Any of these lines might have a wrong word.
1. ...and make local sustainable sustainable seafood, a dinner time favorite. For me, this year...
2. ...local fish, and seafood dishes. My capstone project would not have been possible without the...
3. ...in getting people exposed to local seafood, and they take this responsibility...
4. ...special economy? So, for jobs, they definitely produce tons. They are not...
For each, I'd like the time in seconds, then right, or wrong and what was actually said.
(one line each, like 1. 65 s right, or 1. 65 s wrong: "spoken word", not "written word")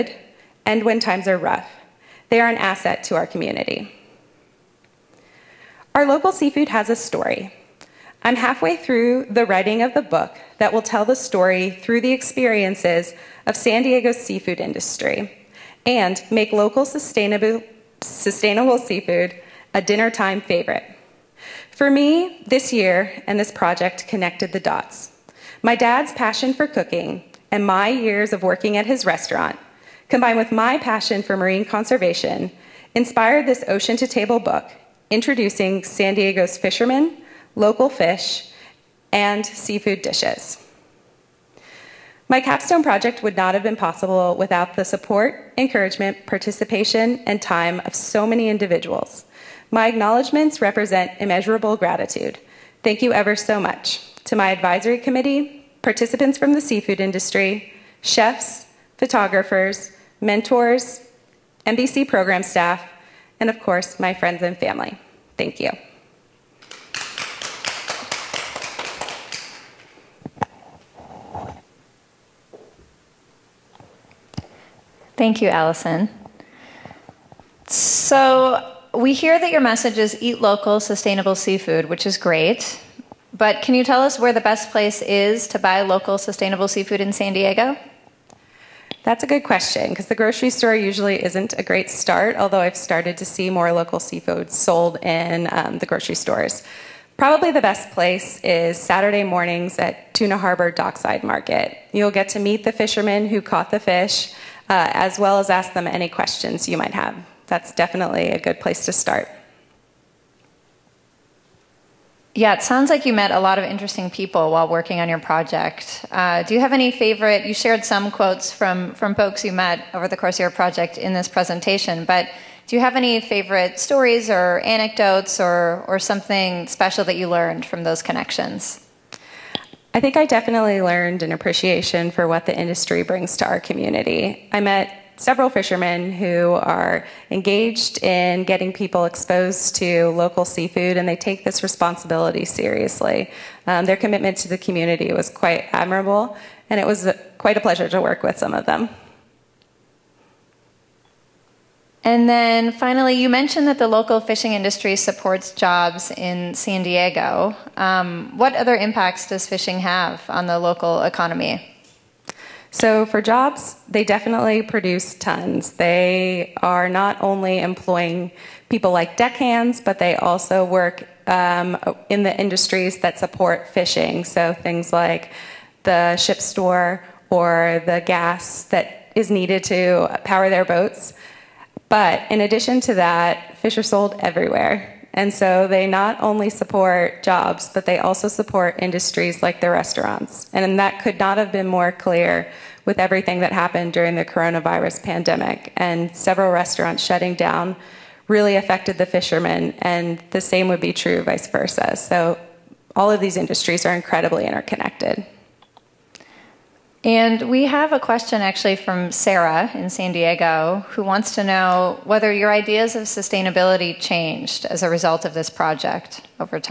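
1. 15 s right
2. 37 s right
3. 138 s right
4. 160 s wrong: "local", not "special".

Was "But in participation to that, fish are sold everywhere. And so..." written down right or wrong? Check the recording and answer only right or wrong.
wrong.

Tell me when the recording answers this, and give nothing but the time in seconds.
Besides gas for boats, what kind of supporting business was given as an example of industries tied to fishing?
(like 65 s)
175 s.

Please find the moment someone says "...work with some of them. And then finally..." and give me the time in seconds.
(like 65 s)
148 s.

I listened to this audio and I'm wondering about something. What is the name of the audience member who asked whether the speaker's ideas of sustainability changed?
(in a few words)
Sarah.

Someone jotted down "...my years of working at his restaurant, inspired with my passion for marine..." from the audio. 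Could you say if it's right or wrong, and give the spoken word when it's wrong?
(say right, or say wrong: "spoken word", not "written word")
wrong: "combined", not "inspired".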